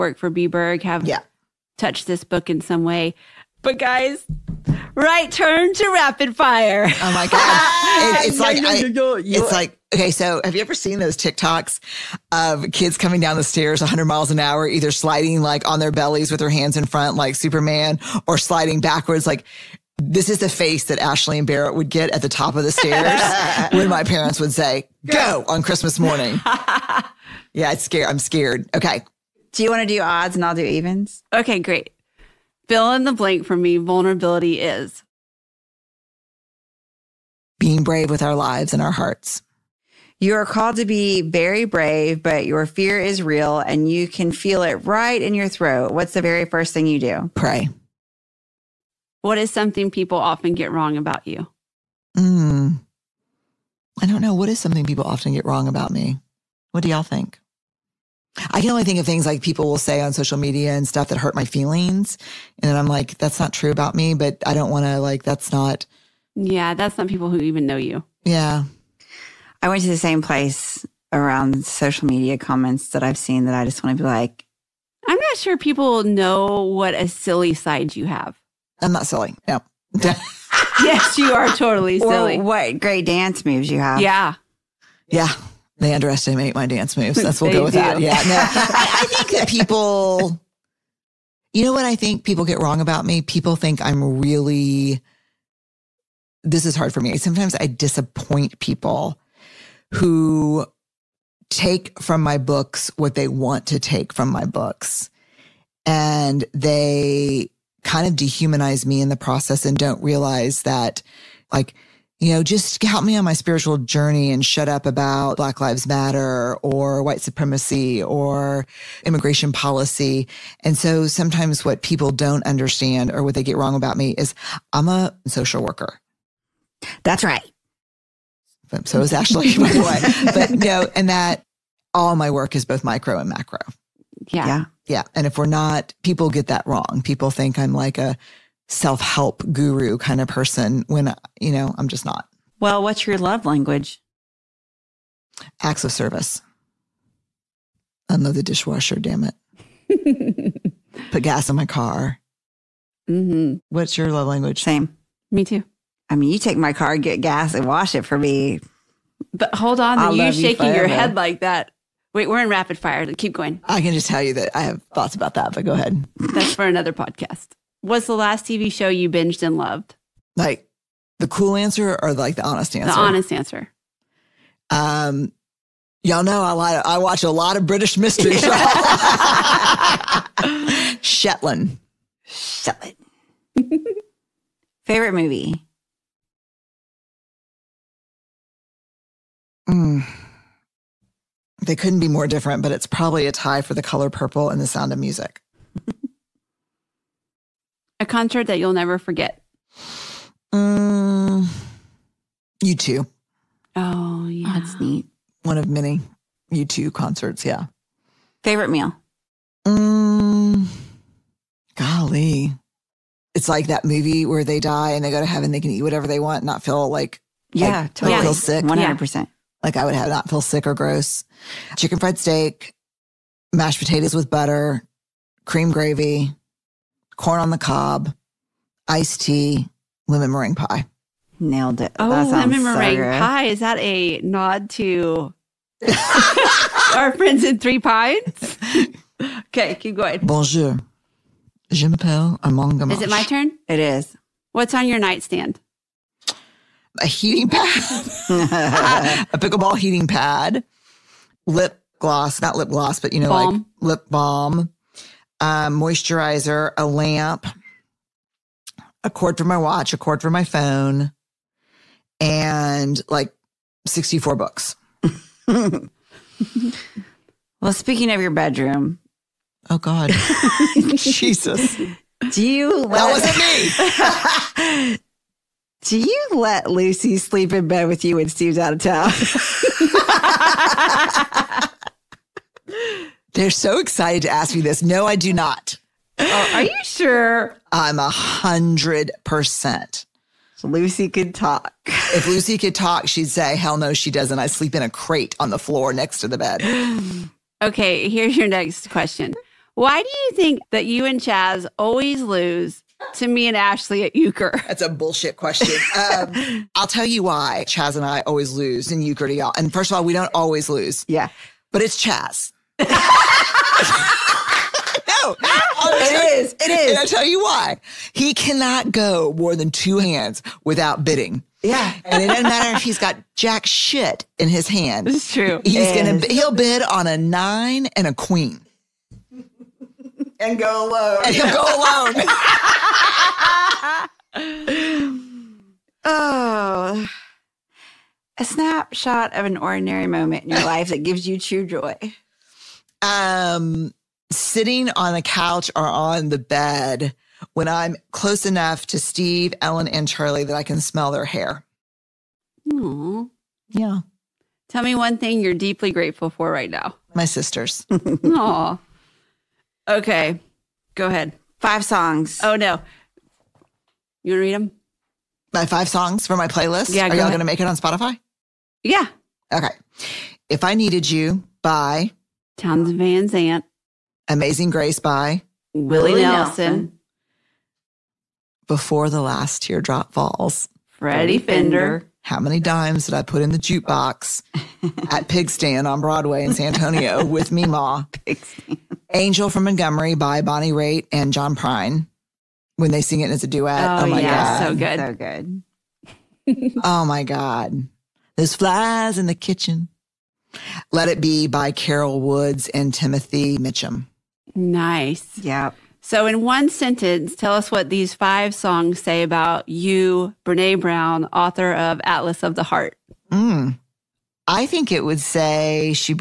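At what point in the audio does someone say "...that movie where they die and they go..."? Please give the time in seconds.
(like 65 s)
213 s.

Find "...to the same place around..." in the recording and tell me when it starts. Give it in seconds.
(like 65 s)
69 s.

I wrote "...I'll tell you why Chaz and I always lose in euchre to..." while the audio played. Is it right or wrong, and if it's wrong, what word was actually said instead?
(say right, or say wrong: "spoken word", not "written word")
right.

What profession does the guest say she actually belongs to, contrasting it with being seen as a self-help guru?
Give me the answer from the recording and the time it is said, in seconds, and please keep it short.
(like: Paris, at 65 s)
Social worker, at 124 s.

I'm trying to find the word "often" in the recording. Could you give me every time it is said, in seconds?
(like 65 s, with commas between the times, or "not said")
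50 s, 55 s.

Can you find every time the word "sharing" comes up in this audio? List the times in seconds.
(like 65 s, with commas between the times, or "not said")
not said.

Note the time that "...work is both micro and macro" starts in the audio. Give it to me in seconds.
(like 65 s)
132 s.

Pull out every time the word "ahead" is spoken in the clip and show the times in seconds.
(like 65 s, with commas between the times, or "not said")
165 s, 361 s.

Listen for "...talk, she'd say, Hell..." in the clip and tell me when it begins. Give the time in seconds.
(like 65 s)
292 s.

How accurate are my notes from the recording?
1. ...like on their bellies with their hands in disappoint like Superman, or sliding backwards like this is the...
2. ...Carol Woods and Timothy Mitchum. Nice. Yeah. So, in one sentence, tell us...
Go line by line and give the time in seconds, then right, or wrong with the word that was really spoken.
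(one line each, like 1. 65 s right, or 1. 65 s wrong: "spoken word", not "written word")
1. 15 s wrong: "front", not "disappoint"
2. 401 s right.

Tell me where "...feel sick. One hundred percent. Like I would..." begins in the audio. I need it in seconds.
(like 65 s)
218 s.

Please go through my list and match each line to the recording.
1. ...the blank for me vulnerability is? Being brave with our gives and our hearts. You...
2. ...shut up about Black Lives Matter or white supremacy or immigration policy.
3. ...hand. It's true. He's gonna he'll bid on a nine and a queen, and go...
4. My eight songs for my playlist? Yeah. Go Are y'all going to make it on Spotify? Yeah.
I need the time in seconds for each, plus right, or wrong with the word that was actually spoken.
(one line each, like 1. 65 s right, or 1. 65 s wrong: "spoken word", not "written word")
1. 33 s wrong: "lives", not "gives"
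2. 114 s right
3. 324 s right
4. 365 s wrong: "five", not "eight".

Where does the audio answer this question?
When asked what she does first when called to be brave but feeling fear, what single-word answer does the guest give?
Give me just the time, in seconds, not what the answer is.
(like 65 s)
47 s.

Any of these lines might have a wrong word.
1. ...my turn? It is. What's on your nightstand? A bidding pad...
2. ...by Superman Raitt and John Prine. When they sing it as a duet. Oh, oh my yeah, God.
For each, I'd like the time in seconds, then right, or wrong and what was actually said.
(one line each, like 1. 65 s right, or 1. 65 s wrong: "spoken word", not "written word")
1. 243 s wrong: "heating", not "bidding"
2. 390 s wrong: "Bonnie", not "Superman".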